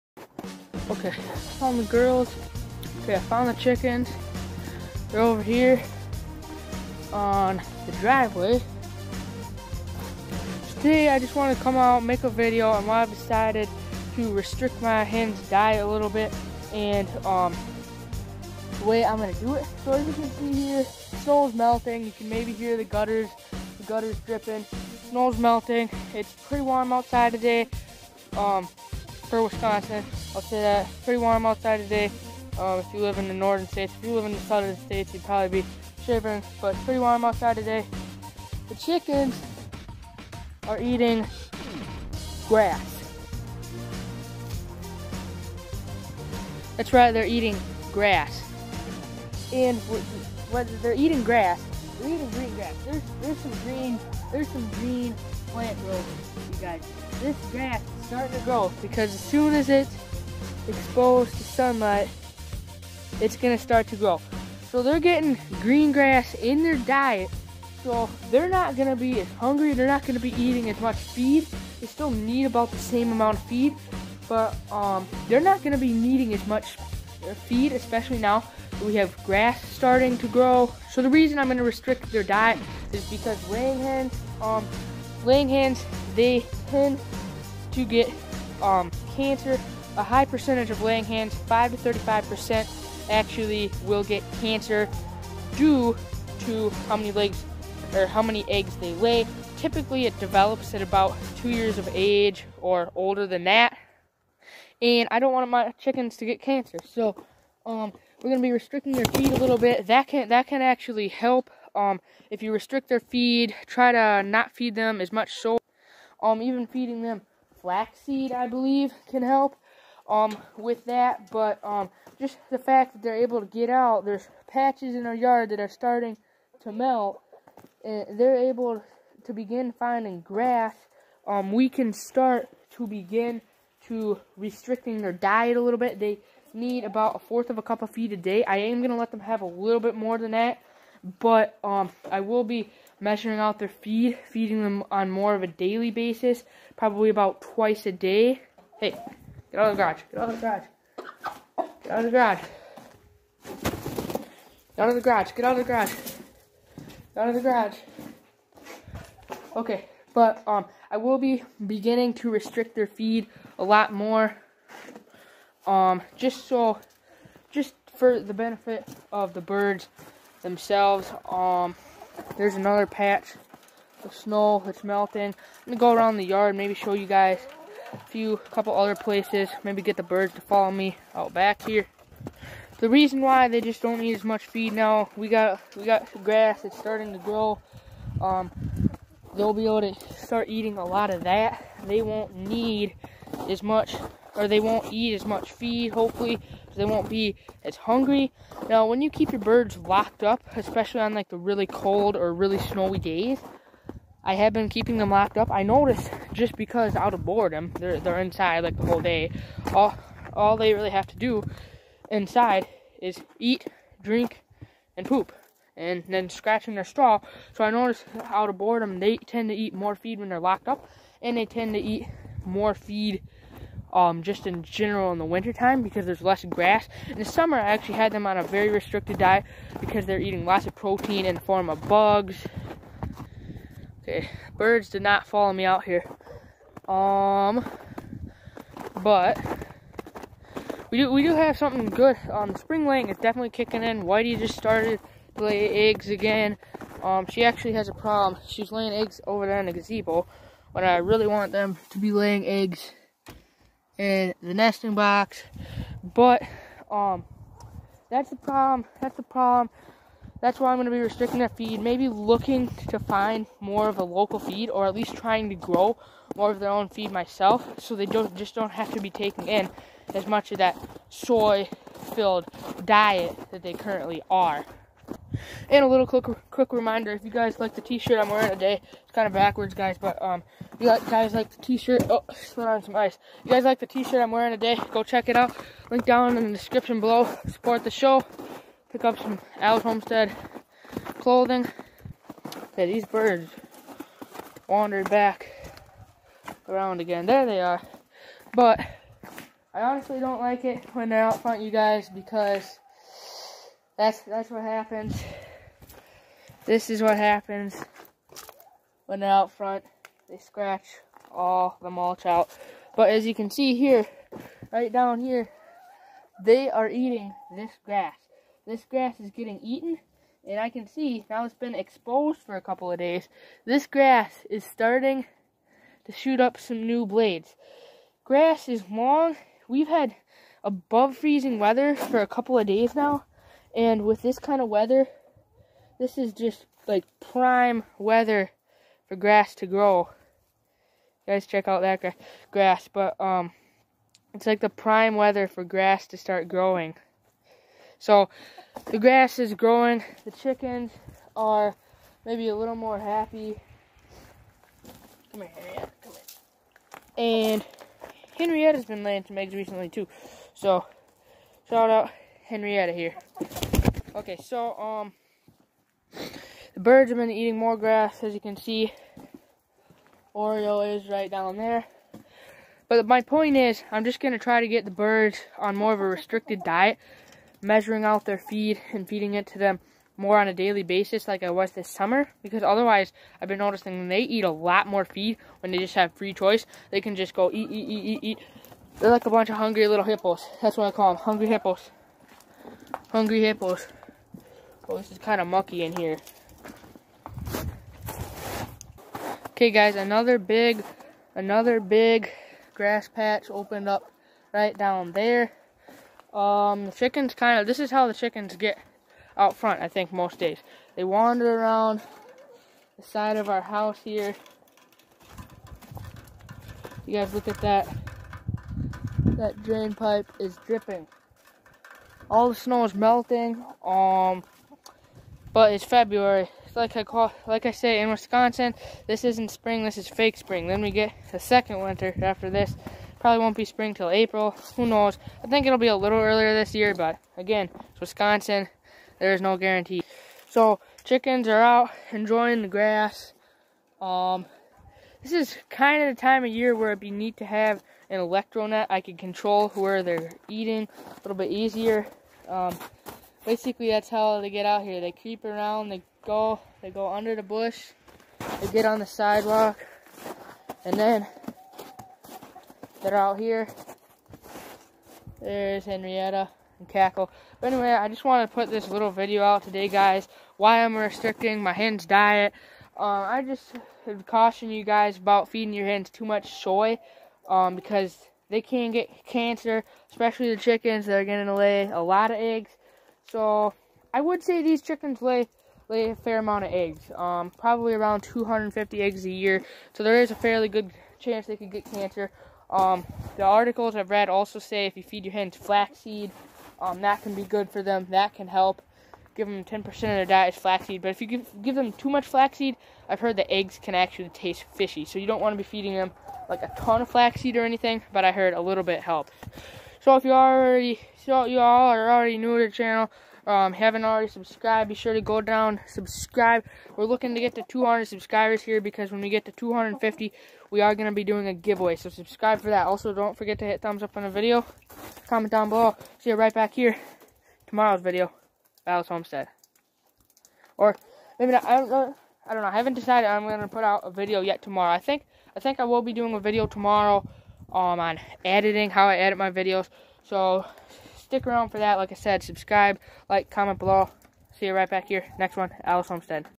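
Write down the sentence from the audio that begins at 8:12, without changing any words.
Um, the articles I've read also say if you feed your hens flaxseed, um, that can be good for them.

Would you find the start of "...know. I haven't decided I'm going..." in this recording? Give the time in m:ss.
8:52.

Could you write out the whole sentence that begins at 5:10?
They scratch all the mulch out.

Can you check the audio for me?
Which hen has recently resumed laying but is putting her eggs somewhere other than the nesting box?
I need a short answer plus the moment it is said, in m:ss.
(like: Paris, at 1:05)
Whitey, at 4:04.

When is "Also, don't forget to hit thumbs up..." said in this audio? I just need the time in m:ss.
8:42.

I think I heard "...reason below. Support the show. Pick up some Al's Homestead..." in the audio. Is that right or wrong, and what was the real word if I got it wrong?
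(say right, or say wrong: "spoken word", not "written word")
wrong: "description", not "reason".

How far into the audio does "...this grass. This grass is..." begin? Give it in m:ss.
5:17.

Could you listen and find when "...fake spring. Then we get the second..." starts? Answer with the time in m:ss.
7:10.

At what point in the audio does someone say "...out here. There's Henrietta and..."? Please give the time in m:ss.
7:43.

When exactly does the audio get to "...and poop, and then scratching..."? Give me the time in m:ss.
3:34.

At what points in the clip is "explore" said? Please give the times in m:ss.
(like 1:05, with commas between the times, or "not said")
not said.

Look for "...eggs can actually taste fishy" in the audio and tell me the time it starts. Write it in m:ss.
8:23.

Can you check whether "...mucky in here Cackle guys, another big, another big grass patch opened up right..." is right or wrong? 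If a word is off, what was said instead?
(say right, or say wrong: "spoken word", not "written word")
wrong: "Okay", not "Cackle".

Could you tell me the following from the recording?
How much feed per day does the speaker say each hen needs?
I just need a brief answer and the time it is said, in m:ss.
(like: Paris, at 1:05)
a fourth of a cup, at 2:17.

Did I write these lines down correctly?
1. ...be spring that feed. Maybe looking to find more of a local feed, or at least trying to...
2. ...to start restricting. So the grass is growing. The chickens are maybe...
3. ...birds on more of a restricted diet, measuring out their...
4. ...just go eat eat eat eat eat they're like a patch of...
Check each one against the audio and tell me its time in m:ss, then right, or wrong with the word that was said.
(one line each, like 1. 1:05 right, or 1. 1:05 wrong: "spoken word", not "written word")
1. 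4:20 wrong: "restricting", not "spring"
2. 5:46 wrong: "growing", not "restricting"
3. 6:14 right
4. 6:27 wrong: "bunch", not "patch".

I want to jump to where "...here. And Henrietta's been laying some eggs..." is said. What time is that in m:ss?
5:56.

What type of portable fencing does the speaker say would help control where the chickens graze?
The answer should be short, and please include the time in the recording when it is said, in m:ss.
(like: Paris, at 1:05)
electro net, at 7:28.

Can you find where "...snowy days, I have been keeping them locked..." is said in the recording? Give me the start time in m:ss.
3:22.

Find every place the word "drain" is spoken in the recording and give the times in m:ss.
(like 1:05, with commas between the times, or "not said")
6:59.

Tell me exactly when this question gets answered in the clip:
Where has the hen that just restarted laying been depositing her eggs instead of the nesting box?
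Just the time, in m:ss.
4:09.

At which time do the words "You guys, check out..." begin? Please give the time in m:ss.
5:41.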